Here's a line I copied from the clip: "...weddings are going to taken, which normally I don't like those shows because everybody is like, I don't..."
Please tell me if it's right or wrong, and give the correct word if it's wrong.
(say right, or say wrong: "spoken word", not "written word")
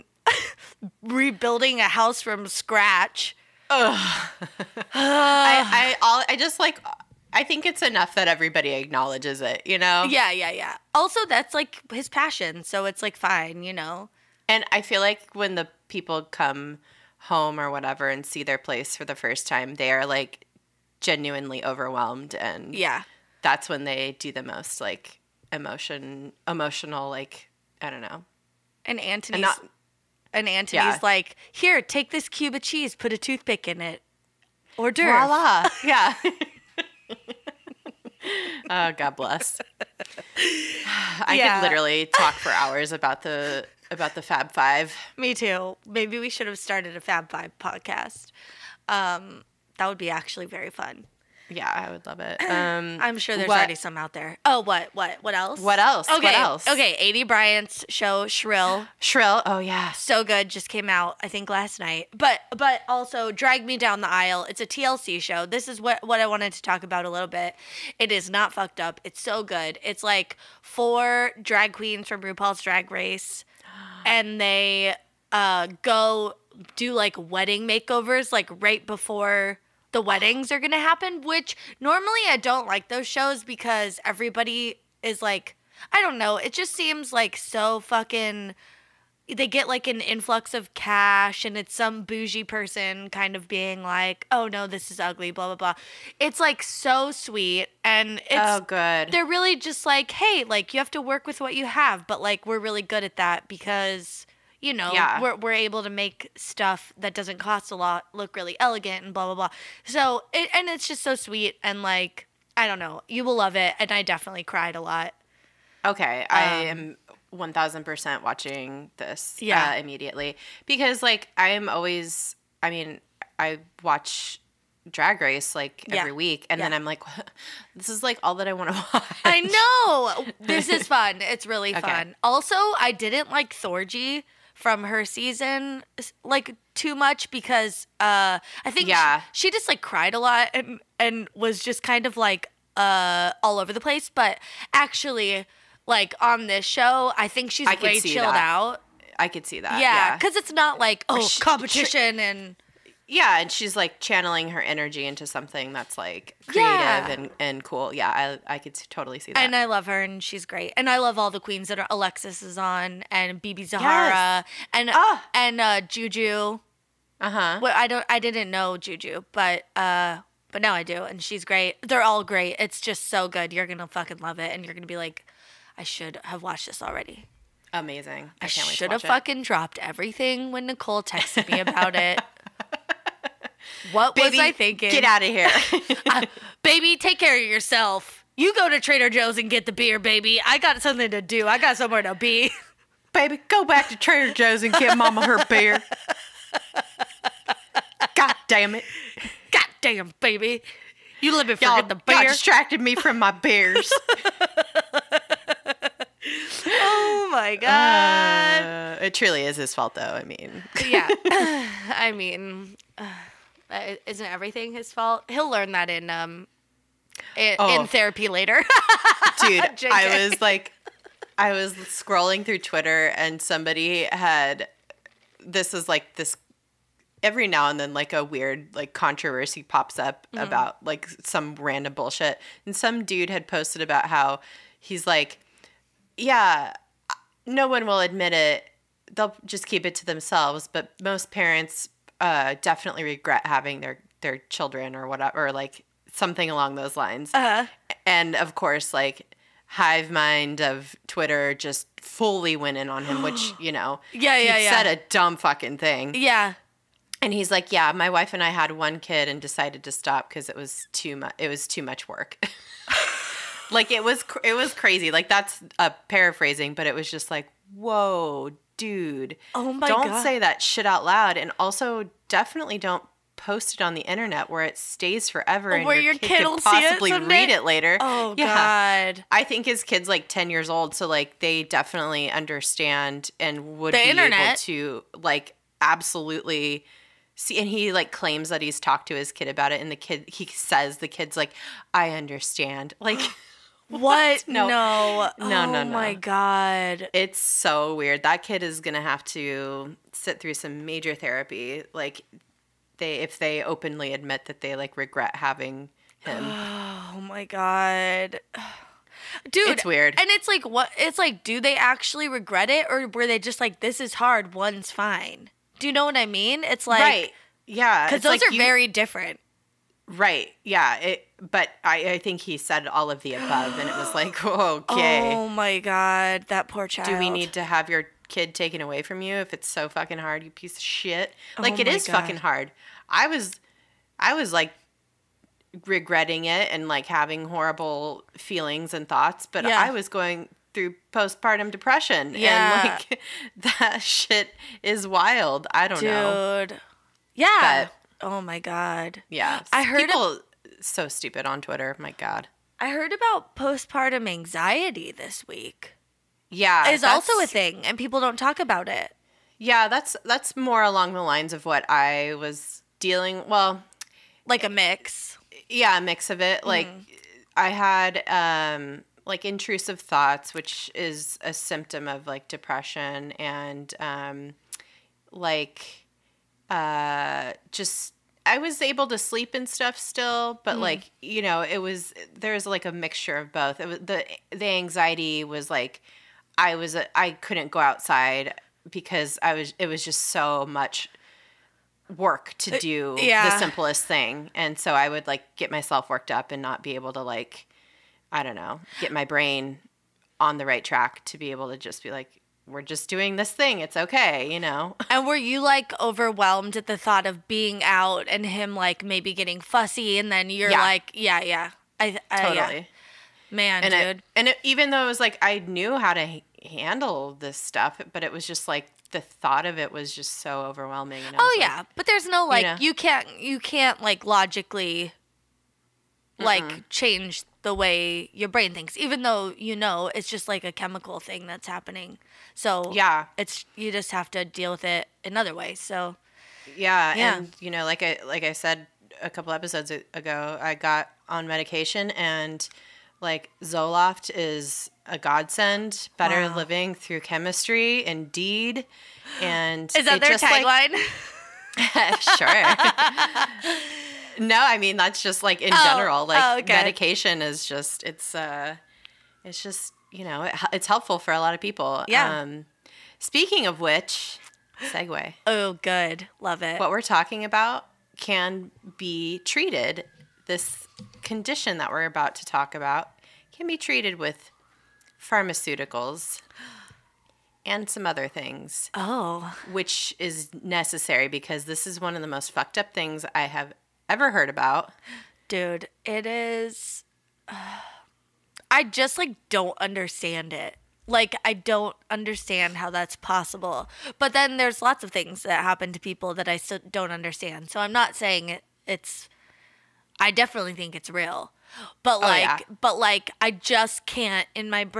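wrong: "happen", not "taken".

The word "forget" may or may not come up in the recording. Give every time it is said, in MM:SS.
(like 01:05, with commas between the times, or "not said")
03:21.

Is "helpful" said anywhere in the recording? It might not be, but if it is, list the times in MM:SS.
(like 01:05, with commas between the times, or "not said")
07:40.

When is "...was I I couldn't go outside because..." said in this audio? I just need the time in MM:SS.
06:26.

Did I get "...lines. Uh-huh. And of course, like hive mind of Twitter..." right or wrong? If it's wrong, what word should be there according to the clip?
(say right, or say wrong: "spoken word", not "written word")
right.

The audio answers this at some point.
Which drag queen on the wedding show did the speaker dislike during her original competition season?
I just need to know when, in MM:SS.
02:13.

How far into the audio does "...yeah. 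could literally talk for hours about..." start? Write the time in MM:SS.
00:41.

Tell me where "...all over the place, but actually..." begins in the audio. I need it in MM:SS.
02:23.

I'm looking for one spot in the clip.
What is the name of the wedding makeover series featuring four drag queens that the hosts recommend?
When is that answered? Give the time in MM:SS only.
01:03.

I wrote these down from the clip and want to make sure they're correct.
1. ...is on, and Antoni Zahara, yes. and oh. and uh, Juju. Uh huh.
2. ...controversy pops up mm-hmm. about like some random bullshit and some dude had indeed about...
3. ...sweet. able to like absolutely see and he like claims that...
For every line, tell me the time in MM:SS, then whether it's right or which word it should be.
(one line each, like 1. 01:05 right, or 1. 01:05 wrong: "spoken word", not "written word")
1. 02:42 wrong: "BeBe", not "Antoni"
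2. 03:48 wrong: "posted", not "indeed"
3. 04:44 wrong: "internet", not "sweet".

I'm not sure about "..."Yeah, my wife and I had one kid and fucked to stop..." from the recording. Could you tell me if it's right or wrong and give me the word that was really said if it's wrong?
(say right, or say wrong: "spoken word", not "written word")
wrong: "decided", not "fucked".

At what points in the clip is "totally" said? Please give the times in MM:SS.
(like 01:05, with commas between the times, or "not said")
02:38, 06:52.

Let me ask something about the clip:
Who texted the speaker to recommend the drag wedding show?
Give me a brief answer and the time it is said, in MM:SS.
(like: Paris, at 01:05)
Nicole, at 03:00.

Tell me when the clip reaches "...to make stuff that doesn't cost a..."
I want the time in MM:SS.
01:45.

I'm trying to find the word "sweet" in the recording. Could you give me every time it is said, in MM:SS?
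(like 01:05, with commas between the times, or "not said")
01:37, 01:51.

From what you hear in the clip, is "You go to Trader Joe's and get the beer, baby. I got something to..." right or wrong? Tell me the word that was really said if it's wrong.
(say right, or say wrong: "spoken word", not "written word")
right.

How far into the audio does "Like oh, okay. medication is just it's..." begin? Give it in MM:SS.
07:36.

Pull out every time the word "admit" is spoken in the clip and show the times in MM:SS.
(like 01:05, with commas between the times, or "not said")
03:57, 05:04.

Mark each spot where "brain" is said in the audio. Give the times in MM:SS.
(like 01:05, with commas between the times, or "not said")
06:39, 07:08.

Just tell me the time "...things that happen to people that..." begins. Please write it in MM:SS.
08:15.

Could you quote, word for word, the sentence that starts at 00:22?
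And yeah, that's when they do the most like emotion emotional like I don't know.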